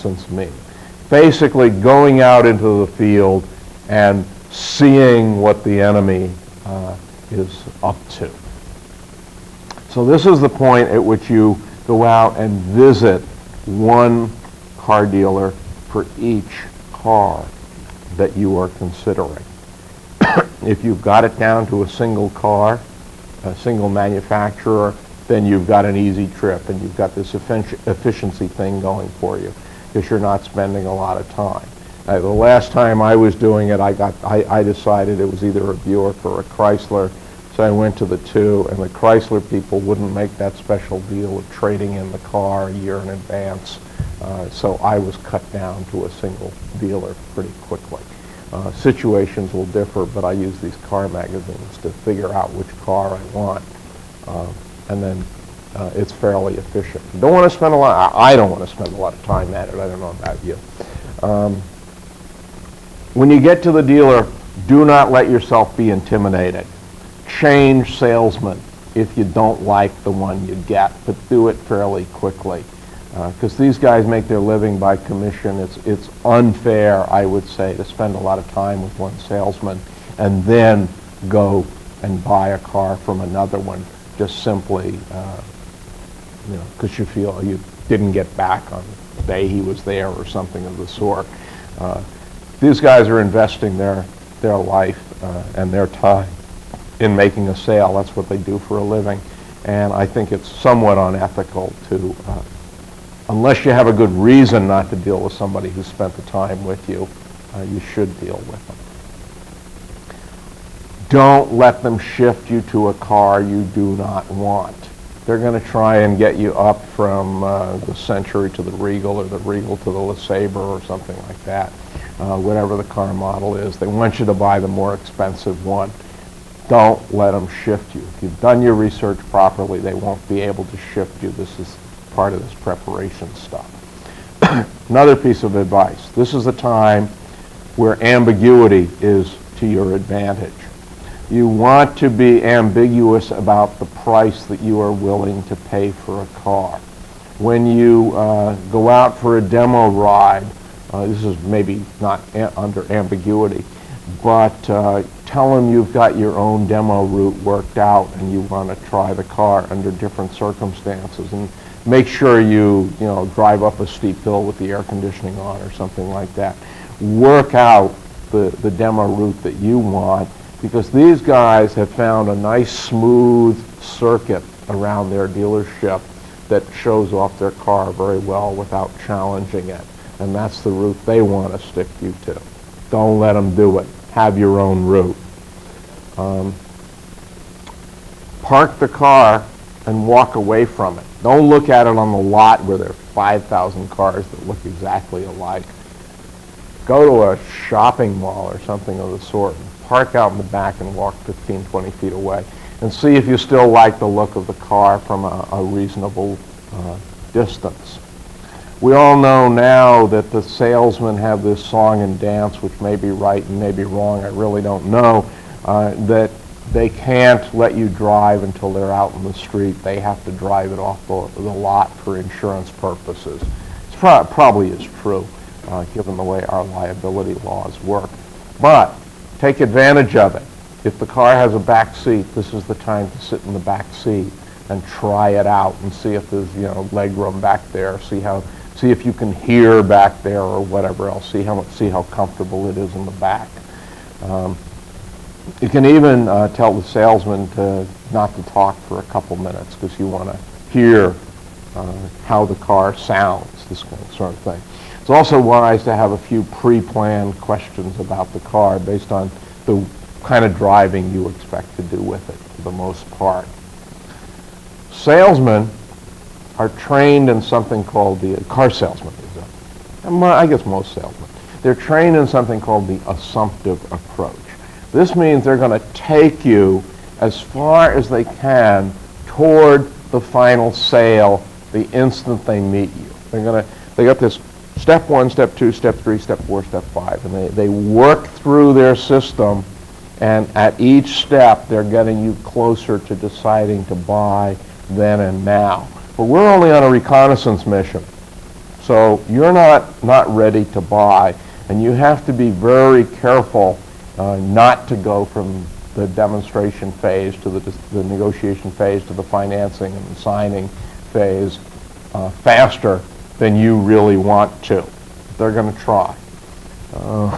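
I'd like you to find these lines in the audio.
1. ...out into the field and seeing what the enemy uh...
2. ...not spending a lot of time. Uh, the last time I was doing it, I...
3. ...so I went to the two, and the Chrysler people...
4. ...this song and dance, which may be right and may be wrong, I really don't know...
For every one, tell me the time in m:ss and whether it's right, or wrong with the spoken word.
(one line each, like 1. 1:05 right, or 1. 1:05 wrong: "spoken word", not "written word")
1. 0:02 right
2. 0:30 right
3. 0:37 right
4. 3:31 right.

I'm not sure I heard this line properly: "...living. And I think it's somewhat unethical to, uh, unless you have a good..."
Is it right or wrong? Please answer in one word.
right.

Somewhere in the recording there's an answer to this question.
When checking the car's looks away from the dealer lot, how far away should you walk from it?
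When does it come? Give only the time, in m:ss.
3:21.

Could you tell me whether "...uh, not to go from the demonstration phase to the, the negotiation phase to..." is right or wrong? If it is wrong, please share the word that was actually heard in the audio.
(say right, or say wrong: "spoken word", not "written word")
right.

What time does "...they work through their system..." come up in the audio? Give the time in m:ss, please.
4:47.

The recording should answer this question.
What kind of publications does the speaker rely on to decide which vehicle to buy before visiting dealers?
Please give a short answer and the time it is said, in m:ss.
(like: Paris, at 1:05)
Car magazines, at 0:50.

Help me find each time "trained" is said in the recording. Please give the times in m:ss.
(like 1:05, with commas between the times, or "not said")
4:26, 4:31.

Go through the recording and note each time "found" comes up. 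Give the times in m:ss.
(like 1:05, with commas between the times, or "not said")
2:51.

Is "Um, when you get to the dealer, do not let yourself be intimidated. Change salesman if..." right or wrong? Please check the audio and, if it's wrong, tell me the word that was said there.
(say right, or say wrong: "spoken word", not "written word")
right.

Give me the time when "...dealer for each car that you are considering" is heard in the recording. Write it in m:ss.
0:15.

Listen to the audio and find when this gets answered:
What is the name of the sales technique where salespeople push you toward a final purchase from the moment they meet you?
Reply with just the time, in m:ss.
4:33.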